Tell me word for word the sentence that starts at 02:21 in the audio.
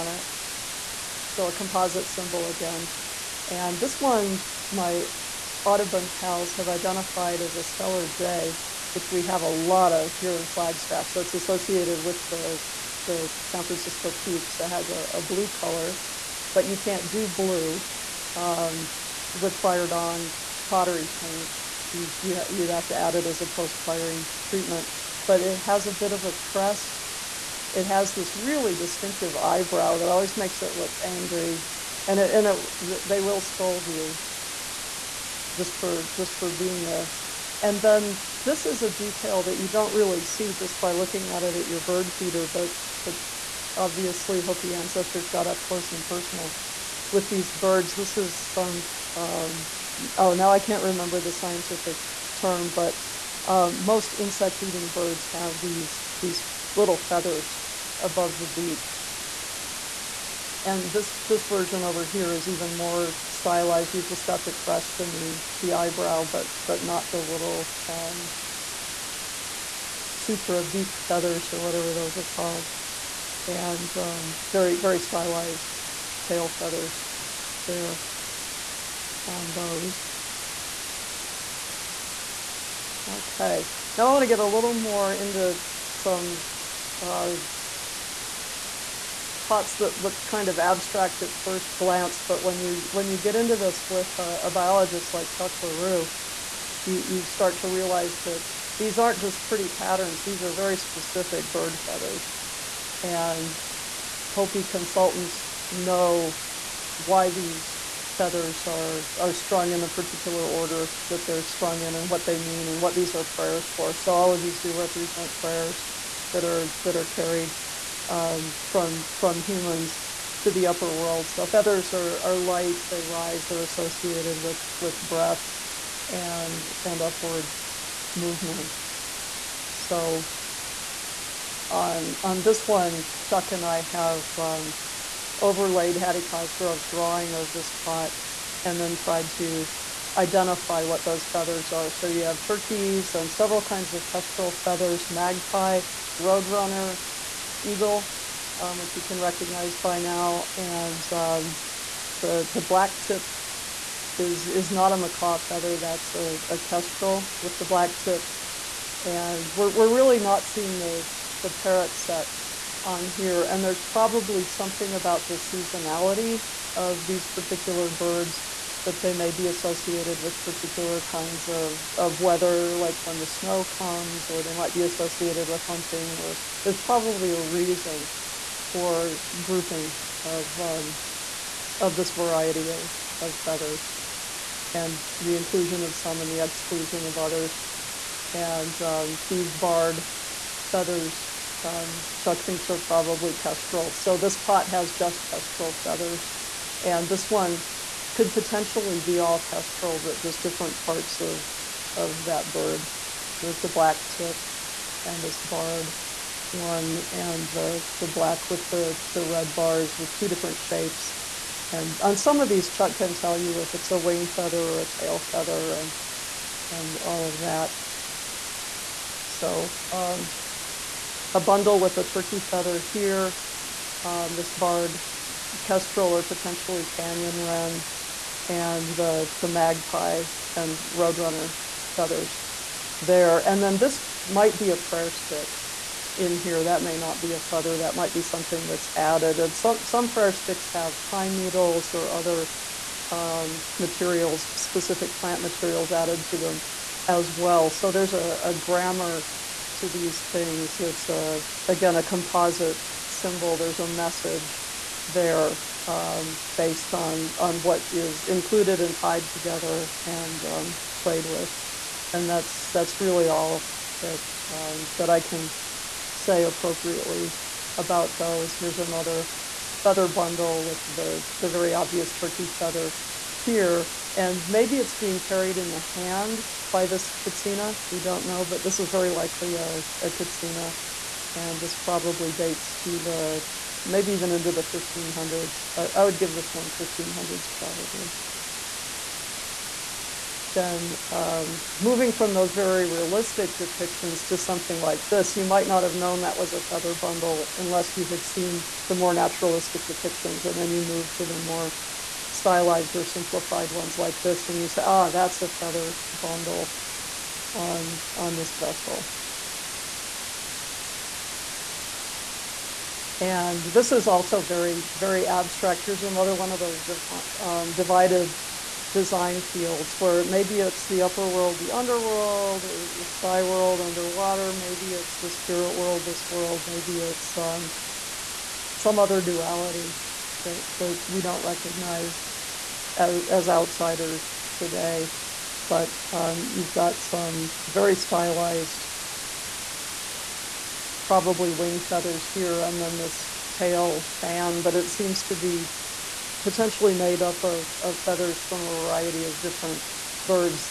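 So you have turkeys and several kinds of kestrel feathers, magpie, Roadrunner Eagle, um, which you can recognize by now.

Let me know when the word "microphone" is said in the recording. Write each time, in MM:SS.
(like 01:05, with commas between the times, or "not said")
not said.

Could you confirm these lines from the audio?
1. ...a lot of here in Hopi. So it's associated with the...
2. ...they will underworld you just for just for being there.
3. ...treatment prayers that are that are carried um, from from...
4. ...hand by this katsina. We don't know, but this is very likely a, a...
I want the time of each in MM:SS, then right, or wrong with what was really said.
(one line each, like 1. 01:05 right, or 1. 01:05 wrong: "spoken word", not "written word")
1. 00:09 wrong: "Flagstaff", not "Hopi"
2. 00:33 wrong: "scold", not "underworld"
3. 01:54 wrong: "represent", not "treatment"
4. 04:35 right.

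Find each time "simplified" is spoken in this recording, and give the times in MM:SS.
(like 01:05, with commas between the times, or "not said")
05:03.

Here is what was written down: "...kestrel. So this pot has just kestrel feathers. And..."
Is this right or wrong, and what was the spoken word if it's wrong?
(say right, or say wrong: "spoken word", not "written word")
right.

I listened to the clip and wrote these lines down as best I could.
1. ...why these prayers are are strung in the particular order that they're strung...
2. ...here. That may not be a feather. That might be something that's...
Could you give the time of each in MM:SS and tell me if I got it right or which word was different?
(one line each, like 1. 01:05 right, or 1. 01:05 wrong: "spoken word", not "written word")
1. 01:46 wrong: "feathers", not "prayers"
2. 03:56 right.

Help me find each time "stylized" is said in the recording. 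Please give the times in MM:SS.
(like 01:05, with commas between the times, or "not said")
01:03, 01:14, 05:02, 05:37.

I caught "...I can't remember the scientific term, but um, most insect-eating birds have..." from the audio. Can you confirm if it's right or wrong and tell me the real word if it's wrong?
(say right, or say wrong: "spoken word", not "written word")
right.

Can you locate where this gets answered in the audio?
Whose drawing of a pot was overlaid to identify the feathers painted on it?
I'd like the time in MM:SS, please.
02:15.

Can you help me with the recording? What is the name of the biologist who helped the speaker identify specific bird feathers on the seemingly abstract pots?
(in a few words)
Chuck LaRue.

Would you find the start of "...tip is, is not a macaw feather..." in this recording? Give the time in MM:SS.
02:33.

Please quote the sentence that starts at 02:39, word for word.
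And we're, we're really not seeing the, the parrot set on here.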